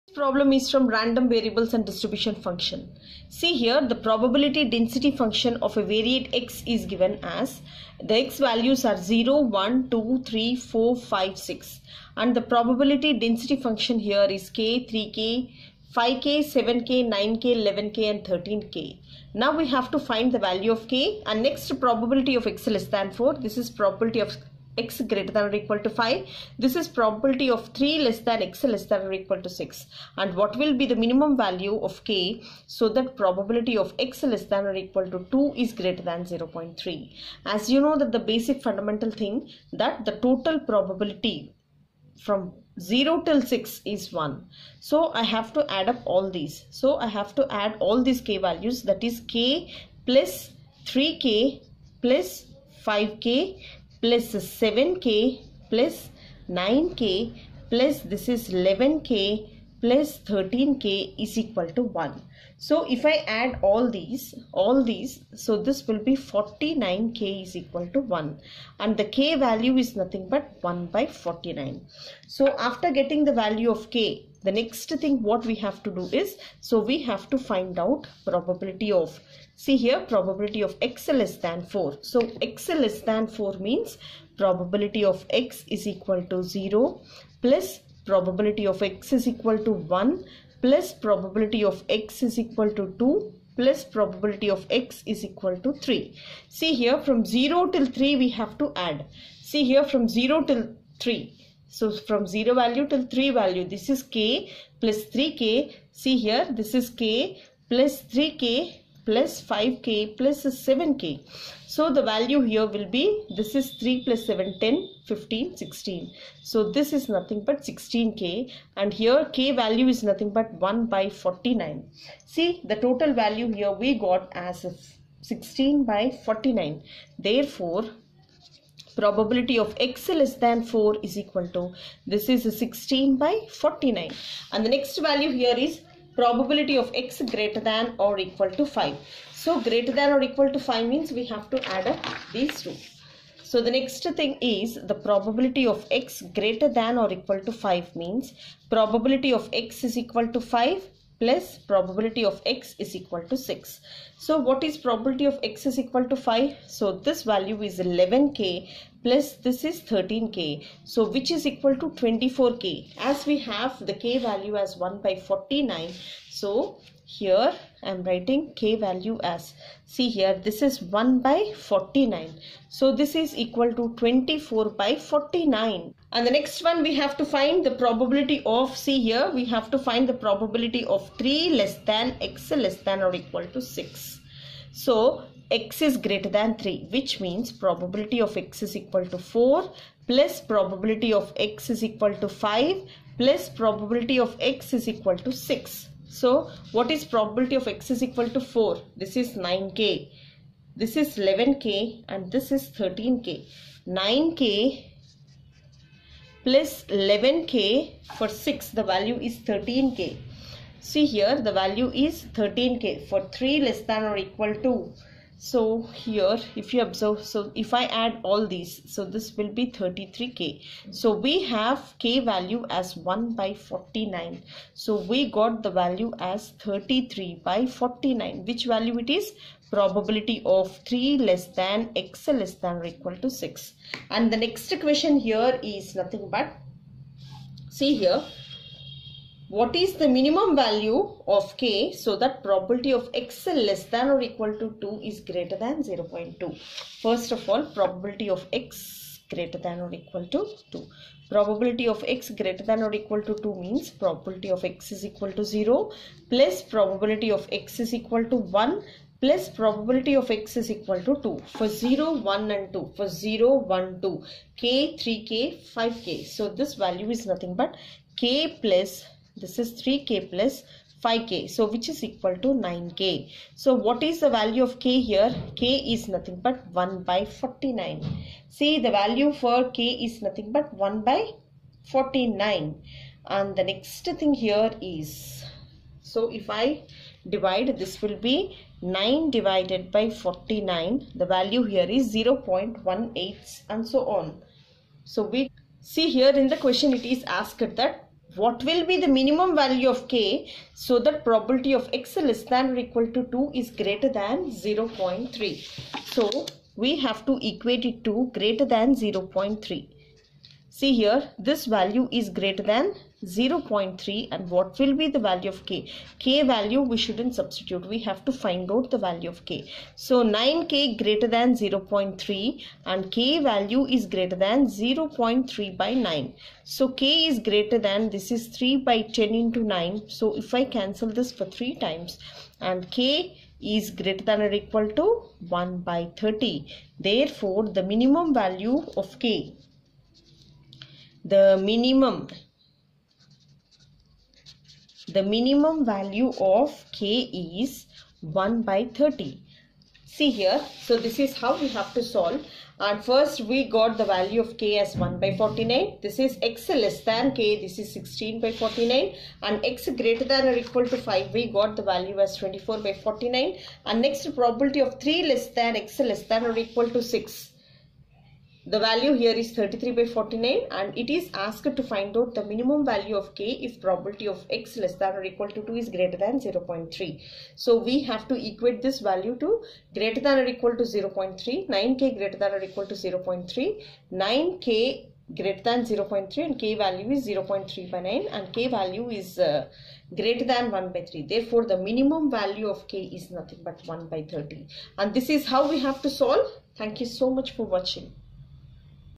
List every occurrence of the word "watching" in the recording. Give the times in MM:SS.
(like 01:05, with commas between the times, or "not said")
06:37.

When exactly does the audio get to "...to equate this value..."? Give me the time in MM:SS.
06:18.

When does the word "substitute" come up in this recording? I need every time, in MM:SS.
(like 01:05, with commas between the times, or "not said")
05:17.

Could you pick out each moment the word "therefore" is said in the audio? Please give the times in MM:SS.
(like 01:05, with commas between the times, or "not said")
02:07, 05:36, 06:31.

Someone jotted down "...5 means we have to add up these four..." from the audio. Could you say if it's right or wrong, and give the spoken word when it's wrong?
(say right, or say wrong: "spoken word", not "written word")
wrong: "two", not "four".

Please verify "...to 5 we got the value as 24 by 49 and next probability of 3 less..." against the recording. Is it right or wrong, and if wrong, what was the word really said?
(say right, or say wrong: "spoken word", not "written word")
right.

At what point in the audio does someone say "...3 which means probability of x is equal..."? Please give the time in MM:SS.
03:06.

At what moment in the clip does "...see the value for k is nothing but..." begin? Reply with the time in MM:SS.
04:38.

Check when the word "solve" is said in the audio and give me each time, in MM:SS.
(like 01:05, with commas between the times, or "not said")
05:52, 06:36.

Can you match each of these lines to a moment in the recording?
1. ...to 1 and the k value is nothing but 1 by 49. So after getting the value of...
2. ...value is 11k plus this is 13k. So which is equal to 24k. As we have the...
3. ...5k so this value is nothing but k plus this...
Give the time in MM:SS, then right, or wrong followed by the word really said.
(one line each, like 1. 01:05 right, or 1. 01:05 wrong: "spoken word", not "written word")
1. 01:07 right
2. 02:37 right
3. 04:25 right.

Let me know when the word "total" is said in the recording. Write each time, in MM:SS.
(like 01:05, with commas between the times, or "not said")
00:40, 02:02.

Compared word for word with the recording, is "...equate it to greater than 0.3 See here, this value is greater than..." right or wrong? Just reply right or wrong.
right.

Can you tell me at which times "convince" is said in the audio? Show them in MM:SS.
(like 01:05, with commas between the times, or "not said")
not said.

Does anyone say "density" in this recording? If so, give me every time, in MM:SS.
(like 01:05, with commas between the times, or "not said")
00:04, 00:13.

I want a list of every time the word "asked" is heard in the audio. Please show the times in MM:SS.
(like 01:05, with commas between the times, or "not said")
04:57, 06:11.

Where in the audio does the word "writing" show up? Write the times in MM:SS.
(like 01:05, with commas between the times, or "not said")
02:48.